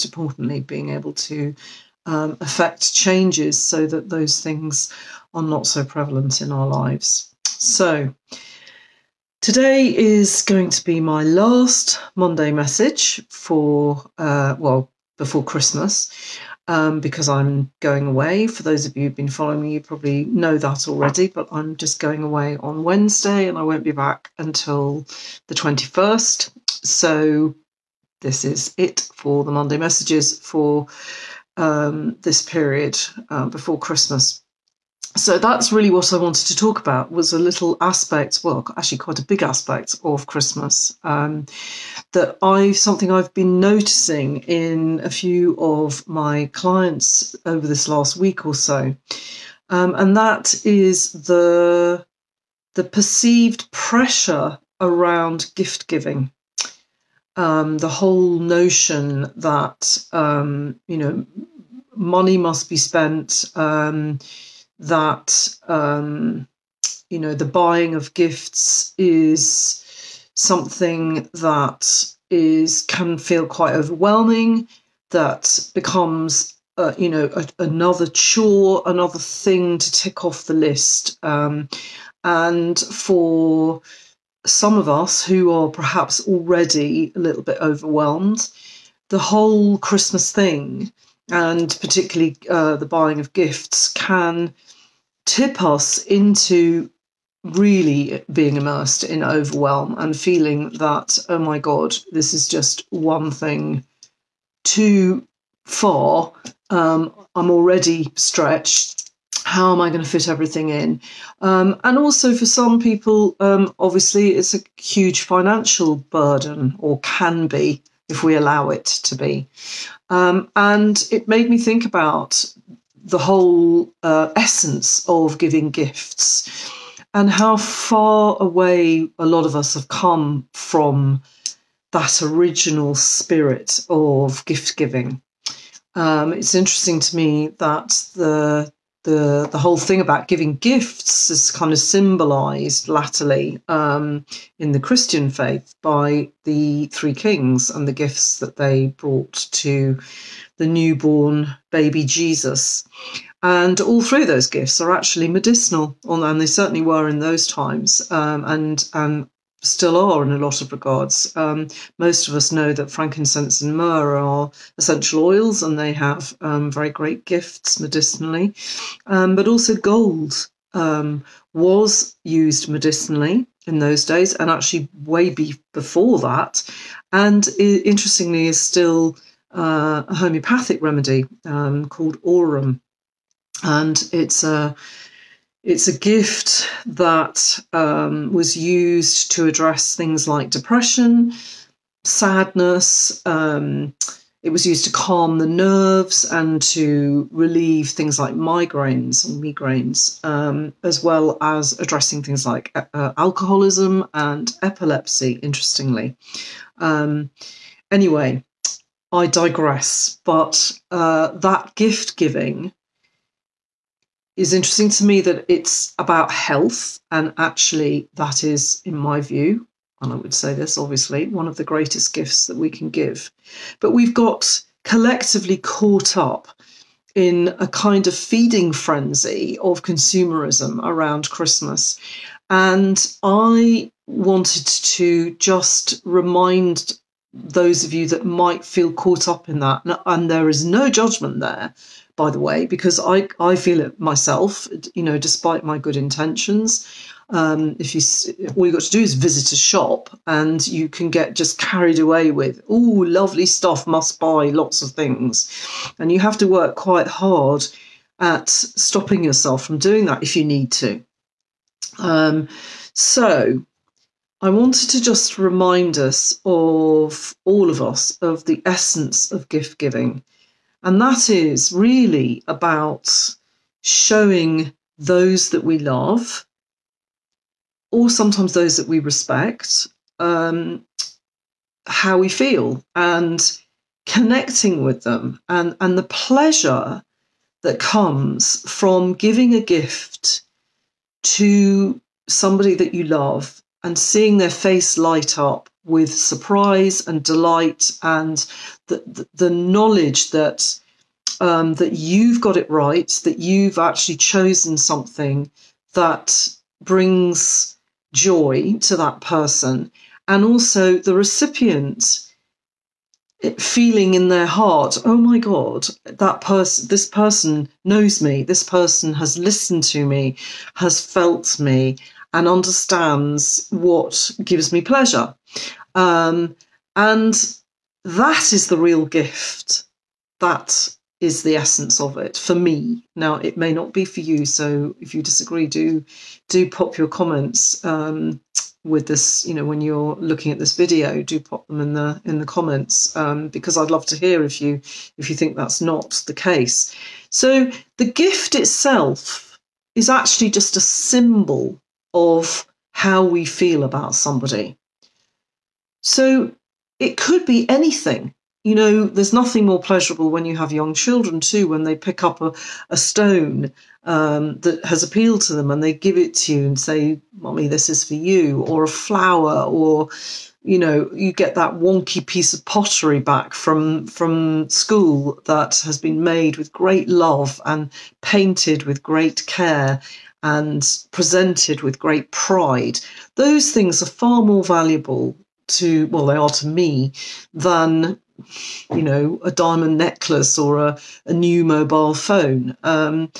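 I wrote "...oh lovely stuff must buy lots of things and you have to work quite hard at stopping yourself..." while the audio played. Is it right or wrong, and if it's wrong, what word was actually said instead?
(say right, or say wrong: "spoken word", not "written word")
right.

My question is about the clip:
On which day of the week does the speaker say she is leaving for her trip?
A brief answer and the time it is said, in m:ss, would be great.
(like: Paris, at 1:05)
Wednesday, at 0:22.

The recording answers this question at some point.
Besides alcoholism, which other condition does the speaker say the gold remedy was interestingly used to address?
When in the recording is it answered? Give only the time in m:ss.
3:24.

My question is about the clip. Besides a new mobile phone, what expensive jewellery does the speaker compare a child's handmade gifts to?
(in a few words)
Diamond necklace.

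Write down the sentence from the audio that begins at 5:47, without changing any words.
So the gift itself is actually just a symbol of how we feel about somebody.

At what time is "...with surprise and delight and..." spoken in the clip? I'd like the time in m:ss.
4:55.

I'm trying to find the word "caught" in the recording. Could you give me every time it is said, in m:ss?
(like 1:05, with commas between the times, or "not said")
3:45, 3:58.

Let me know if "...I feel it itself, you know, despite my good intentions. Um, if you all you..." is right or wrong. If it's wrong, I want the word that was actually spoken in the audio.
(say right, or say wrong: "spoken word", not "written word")
wrong: "myself", not "itself".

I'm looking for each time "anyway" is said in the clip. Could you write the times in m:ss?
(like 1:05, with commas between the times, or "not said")
3:27.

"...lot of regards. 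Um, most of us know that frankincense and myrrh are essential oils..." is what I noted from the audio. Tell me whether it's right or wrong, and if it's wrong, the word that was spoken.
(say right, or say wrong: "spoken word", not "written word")
right.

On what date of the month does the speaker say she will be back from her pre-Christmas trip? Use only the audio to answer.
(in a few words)
21st.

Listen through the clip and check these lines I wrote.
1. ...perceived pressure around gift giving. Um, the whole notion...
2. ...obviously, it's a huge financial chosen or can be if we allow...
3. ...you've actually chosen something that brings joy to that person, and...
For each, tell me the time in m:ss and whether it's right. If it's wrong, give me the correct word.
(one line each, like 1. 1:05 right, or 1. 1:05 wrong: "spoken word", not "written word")
1. 0:52 right
2. 1:53 wrong: "burden", not "chosen"
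3. 5:03 right.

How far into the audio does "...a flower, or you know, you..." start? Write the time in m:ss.
6:08.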